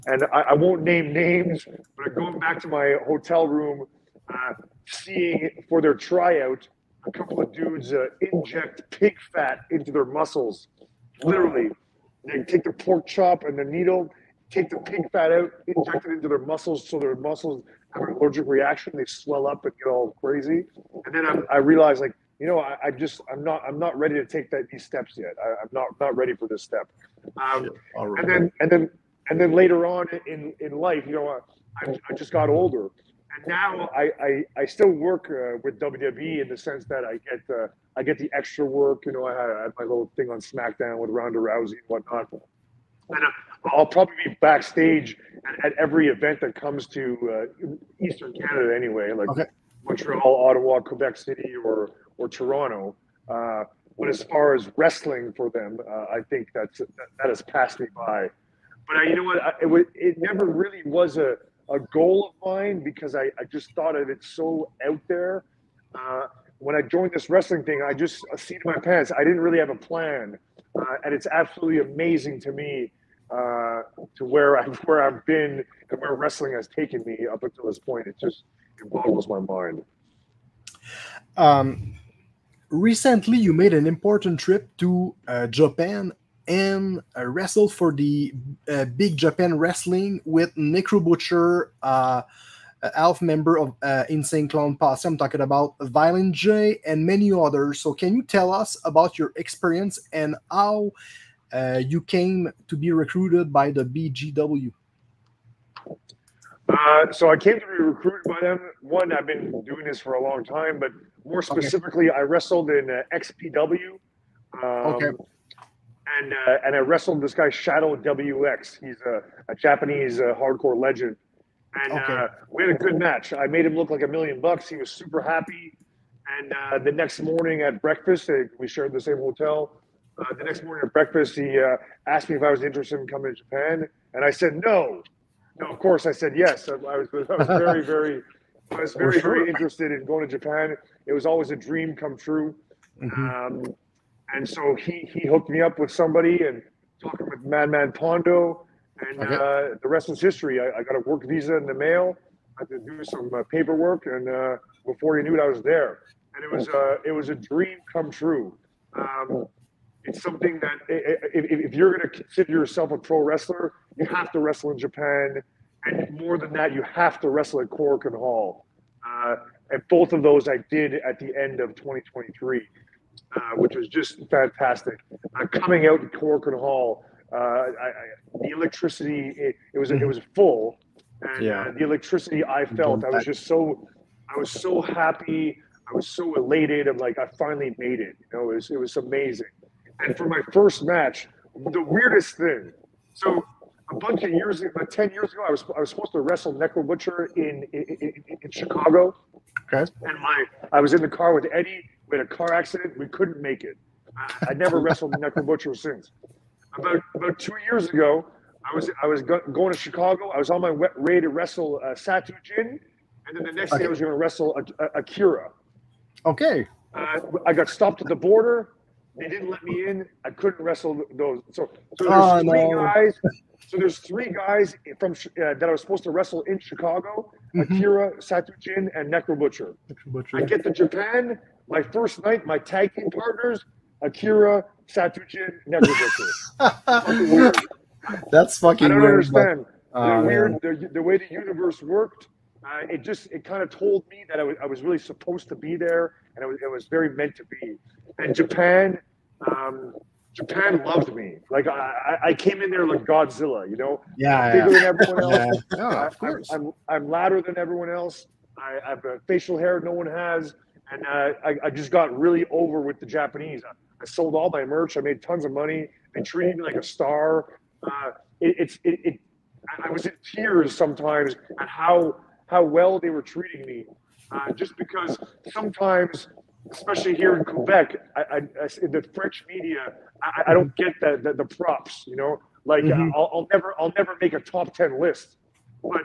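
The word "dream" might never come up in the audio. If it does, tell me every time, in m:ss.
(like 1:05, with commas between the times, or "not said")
2:21, 2:37.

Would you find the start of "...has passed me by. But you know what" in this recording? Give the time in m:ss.
0:57.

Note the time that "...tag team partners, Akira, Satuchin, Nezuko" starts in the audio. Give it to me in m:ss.
3:52.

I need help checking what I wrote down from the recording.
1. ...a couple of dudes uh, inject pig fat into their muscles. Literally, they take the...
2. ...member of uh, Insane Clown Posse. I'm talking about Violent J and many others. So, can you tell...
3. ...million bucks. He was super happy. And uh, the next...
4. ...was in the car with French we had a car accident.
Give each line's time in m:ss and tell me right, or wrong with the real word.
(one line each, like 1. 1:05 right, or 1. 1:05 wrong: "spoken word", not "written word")
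1. 0:07 right
2. 1:33 right
3. 2:04 right
4. 3:20 wrong: "Eddie", not "French".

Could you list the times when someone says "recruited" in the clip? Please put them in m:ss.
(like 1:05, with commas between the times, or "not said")
1:42, 1:47.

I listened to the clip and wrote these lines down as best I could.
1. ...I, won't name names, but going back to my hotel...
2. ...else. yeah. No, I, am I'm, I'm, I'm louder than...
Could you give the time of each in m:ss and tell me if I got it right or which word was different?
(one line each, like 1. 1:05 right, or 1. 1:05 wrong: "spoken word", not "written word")
1. 0:00 right
2. 4:15 right.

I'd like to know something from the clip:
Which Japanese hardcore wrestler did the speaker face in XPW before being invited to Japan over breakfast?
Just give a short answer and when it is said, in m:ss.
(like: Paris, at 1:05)
Shadow WX, at 1:57.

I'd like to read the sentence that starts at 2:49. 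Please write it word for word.
Uh, and both of those I did at the end of 2023.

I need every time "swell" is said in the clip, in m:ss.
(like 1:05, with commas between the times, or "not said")
0:19.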